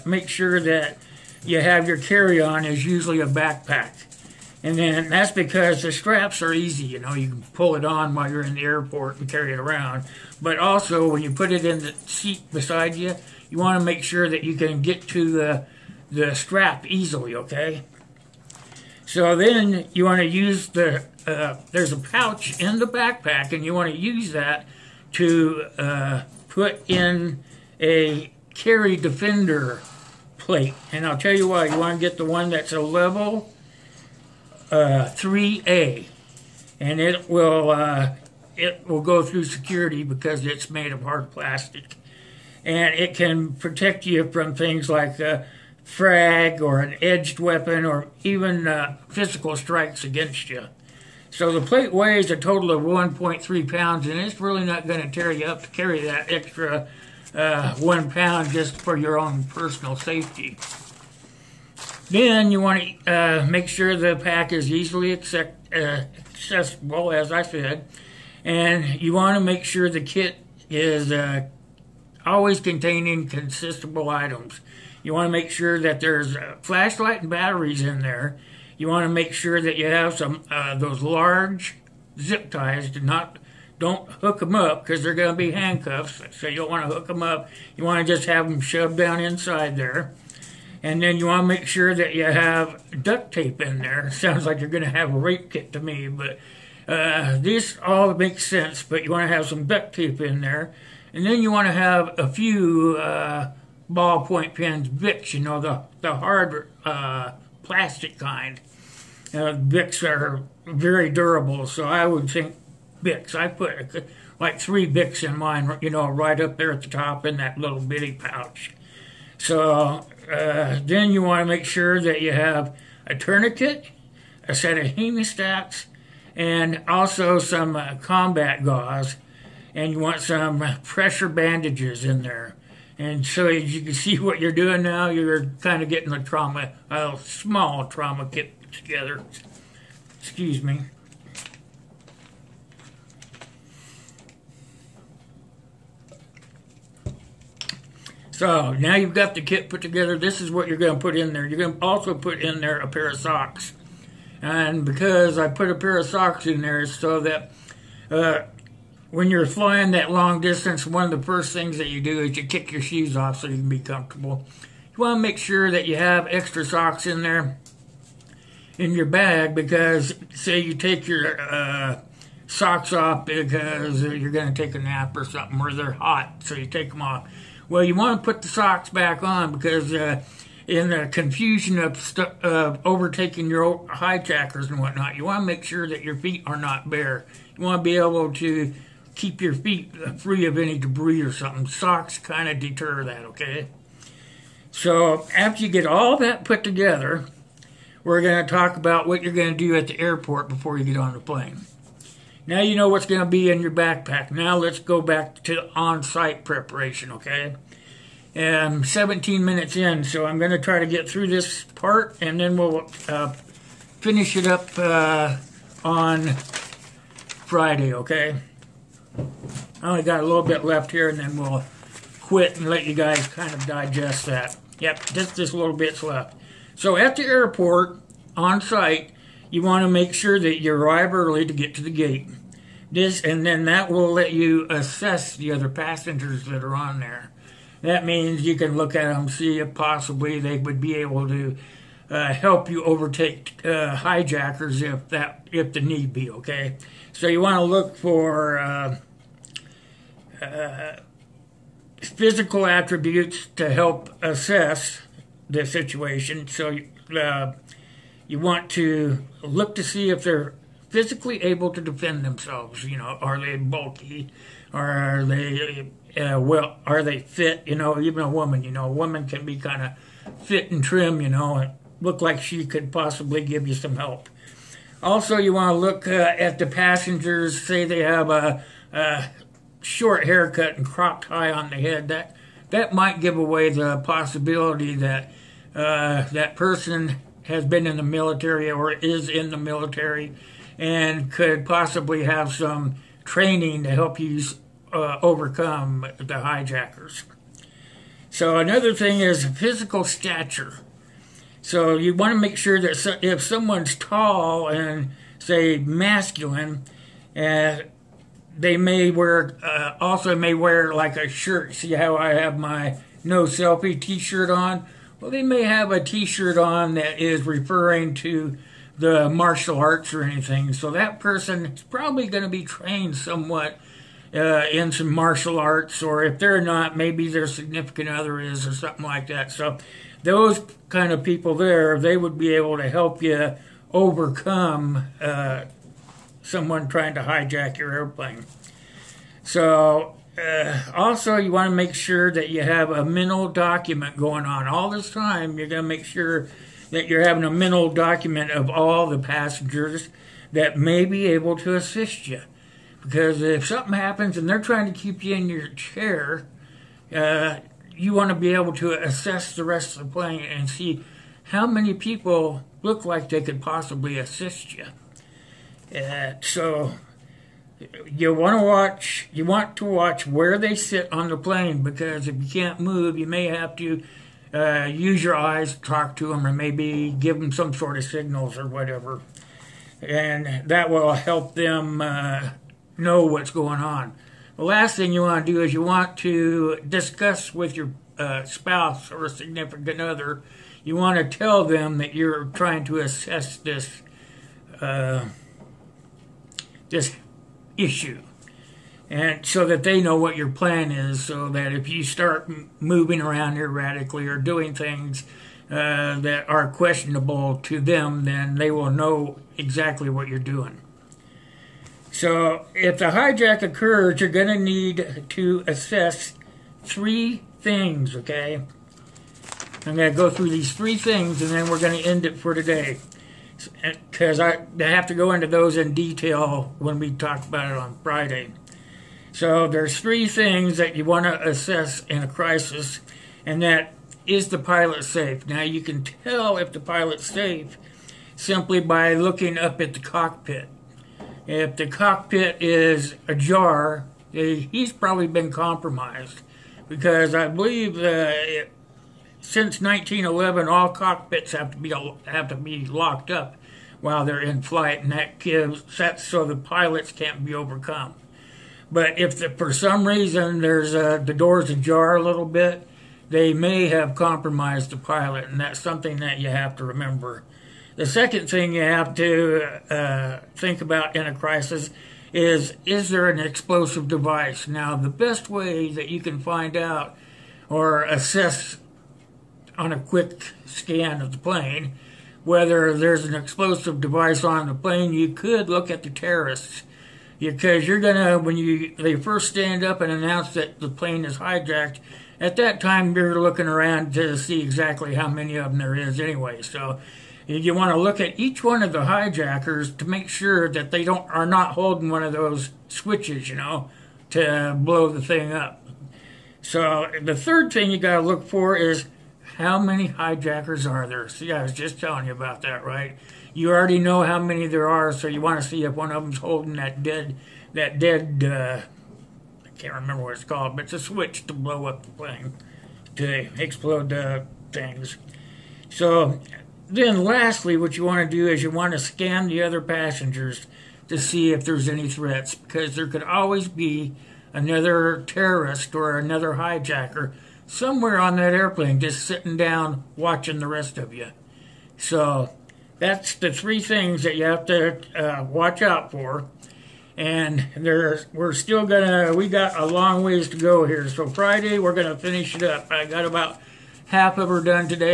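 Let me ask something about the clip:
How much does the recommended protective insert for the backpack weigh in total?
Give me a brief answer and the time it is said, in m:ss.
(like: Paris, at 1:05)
1.3 pounds, at 0:52.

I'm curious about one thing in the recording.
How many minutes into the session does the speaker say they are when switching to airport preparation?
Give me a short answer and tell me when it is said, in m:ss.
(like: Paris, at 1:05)
17, at 3:28.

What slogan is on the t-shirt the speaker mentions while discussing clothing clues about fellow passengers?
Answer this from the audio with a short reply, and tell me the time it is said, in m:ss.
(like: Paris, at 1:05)
no selfie, at 5:13.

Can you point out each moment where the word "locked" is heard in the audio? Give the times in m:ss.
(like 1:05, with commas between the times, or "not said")
7:32.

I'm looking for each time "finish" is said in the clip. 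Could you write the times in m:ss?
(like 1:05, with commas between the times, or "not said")
3:33, 9:12.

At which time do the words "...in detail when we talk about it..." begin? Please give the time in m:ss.
7:05.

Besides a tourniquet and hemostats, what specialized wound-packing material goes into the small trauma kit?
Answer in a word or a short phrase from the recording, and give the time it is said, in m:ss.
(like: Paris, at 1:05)
combat gauze, at 2:07.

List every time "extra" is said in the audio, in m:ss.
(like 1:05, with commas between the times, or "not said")
0:56, 2:46.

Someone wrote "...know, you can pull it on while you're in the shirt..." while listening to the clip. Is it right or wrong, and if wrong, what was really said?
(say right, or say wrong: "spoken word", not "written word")
wrong: "airport", not "shirt".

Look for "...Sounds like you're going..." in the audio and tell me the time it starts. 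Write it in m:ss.
1:34.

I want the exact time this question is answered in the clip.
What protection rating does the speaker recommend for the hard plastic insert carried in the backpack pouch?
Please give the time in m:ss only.
0:32.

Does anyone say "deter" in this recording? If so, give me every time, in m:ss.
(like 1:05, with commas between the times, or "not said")
3:12.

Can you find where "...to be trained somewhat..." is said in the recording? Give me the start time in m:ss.
5:22.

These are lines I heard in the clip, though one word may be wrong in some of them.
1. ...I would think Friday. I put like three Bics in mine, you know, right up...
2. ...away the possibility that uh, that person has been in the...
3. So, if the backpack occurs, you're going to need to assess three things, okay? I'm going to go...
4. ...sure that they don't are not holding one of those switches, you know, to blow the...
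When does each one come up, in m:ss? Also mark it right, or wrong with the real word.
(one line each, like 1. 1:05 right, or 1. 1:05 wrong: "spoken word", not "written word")
1. 1:51 wrong: "Bics", not "Friday"
2. 4:43 right
3. 6:52 wrong: "hijack", not "backpack"
4. 8:20 right.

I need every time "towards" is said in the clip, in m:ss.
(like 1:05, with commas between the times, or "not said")
not said.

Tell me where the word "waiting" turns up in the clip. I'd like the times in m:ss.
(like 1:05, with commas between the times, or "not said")
not said.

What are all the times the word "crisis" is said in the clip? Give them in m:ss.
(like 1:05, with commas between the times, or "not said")
7:12, 7:51.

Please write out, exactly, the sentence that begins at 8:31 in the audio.
See, I was just telling you about that, right?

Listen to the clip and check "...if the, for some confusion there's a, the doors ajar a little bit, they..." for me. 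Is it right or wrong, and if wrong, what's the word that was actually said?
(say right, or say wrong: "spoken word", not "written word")
wrong: "reason", not "confusion".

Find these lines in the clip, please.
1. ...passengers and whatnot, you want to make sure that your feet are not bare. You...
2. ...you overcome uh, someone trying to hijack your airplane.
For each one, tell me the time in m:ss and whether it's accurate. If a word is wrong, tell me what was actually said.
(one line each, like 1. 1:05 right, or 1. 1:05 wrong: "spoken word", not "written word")
1. 3:03 wrong: "hijackers", not "passengers"
2. 5:33 right.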